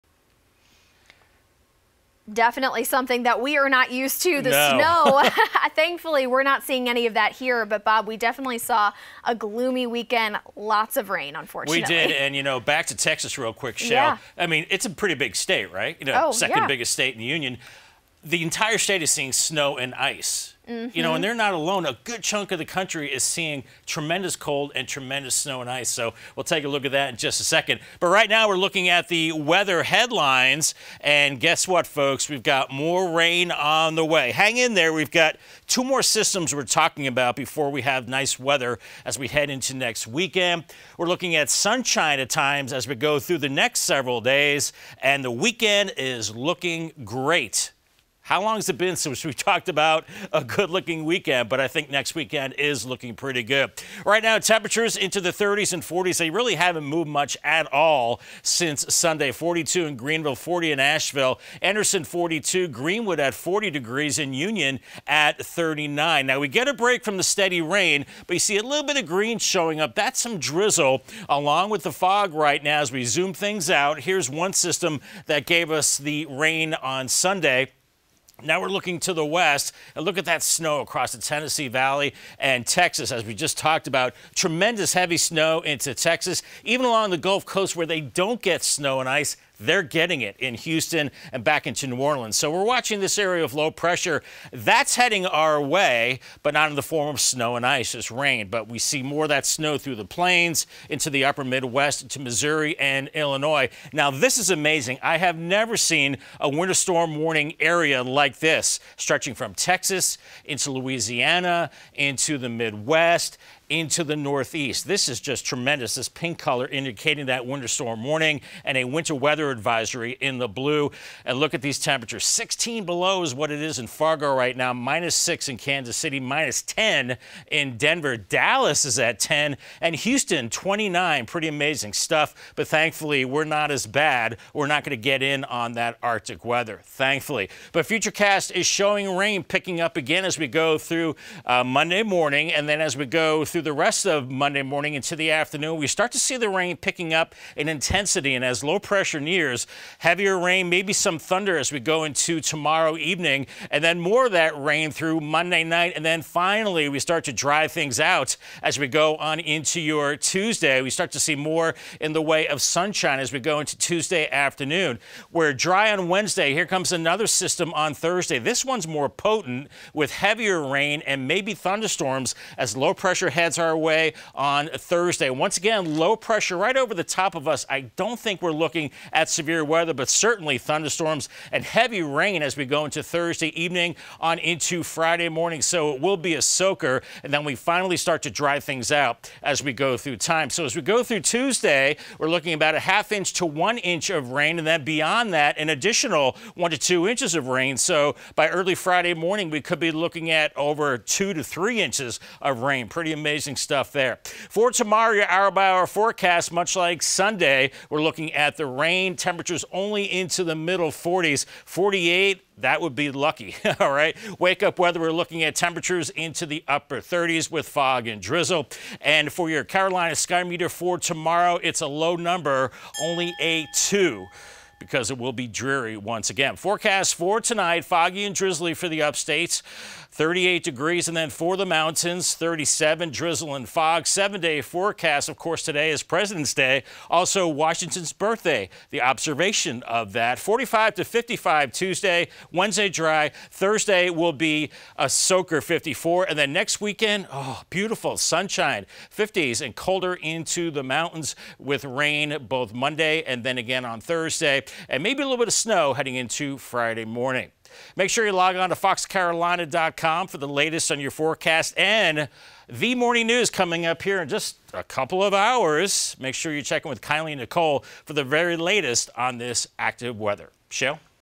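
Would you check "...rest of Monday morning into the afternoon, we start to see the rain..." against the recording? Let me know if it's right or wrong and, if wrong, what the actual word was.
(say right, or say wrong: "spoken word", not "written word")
right.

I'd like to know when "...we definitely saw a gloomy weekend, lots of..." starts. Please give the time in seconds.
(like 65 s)
8 s.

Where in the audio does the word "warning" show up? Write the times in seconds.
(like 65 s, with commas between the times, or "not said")
107 s, 118 s.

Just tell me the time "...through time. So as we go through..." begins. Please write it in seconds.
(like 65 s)
189 s.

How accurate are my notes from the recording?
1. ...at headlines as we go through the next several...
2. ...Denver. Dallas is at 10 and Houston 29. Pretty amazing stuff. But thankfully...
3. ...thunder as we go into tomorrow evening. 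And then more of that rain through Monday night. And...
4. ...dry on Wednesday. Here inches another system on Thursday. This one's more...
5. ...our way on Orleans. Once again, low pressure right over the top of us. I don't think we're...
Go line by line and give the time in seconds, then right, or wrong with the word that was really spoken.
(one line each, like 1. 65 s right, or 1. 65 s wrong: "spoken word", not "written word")
1. 42 s wrong: "times", not "headlines"
2. 127 s right
3. 151 s right
4. 165 s wrong: "comes", not "inches"
5. 173 s wrong: "Thursday", not "Orleans".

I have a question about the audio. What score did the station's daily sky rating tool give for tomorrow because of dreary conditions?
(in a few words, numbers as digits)
2.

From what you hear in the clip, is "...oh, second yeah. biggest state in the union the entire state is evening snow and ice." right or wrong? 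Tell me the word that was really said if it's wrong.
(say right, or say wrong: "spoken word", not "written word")
wrong: "seeing", not "evening".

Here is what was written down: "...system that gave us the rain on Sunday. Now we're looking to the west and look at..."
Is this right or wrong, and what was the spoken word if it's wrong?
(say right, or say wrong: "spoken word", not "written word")
right.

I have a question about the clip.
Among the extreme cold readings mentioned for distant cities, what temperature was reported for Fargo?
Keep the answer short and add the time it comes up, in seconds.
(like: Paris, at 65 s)
-16, at 122 s.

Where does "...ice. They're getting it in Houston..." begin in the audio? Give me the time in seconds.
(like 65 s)
89 s.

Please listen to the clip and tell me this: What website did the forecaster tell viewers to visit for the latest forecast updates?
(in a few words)
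foxcarolina.com.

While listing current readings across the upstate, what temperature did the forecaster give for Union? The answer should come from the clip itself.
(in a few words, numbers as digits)
39.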